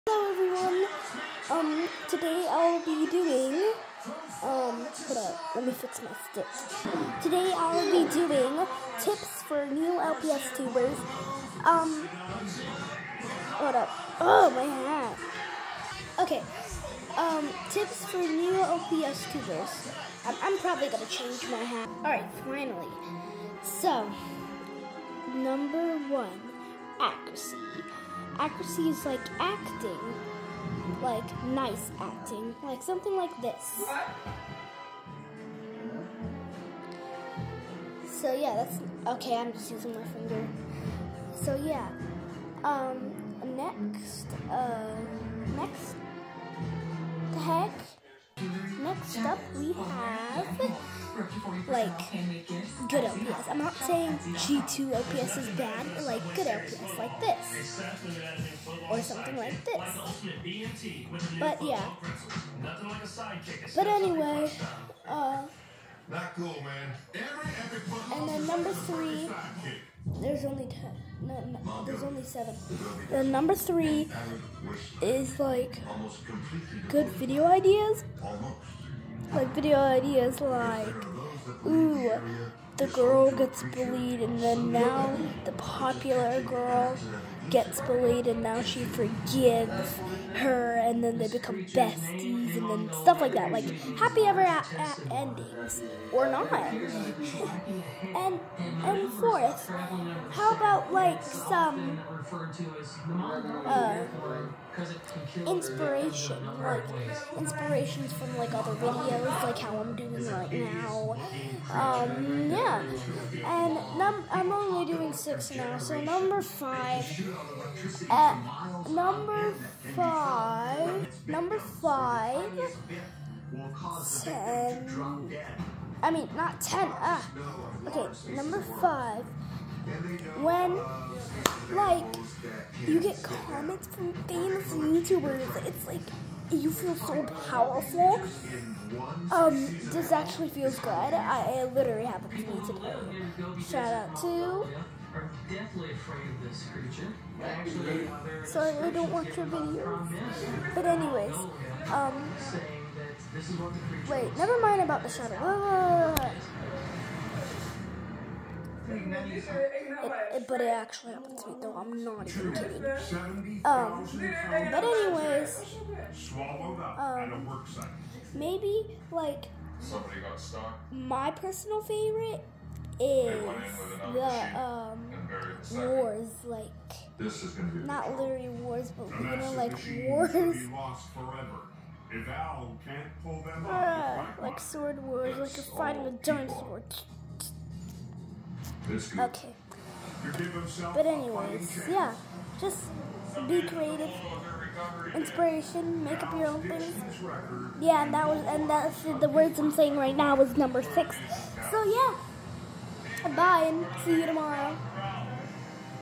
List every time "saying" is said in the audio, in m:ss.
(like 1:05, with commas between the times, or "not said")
0:53, 3:19.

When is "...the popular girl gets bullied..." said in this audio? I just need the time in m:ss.
1:25.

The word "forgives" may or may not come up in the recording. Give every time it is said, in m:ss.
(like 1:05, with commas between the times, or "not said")
1:28.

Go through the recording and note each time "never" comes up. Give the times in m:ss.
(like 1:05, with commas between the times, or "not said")
2:34.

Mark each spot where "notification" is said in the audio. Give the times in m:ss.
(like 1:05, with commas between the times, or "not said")
not said.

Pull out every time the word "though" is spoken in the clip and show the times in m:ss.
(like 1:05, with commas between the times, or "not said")
2:41.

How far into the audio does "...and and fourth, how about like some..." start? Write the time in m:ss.
1:38.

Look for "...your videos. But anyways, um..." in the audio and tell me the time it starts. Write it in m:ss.
2:29.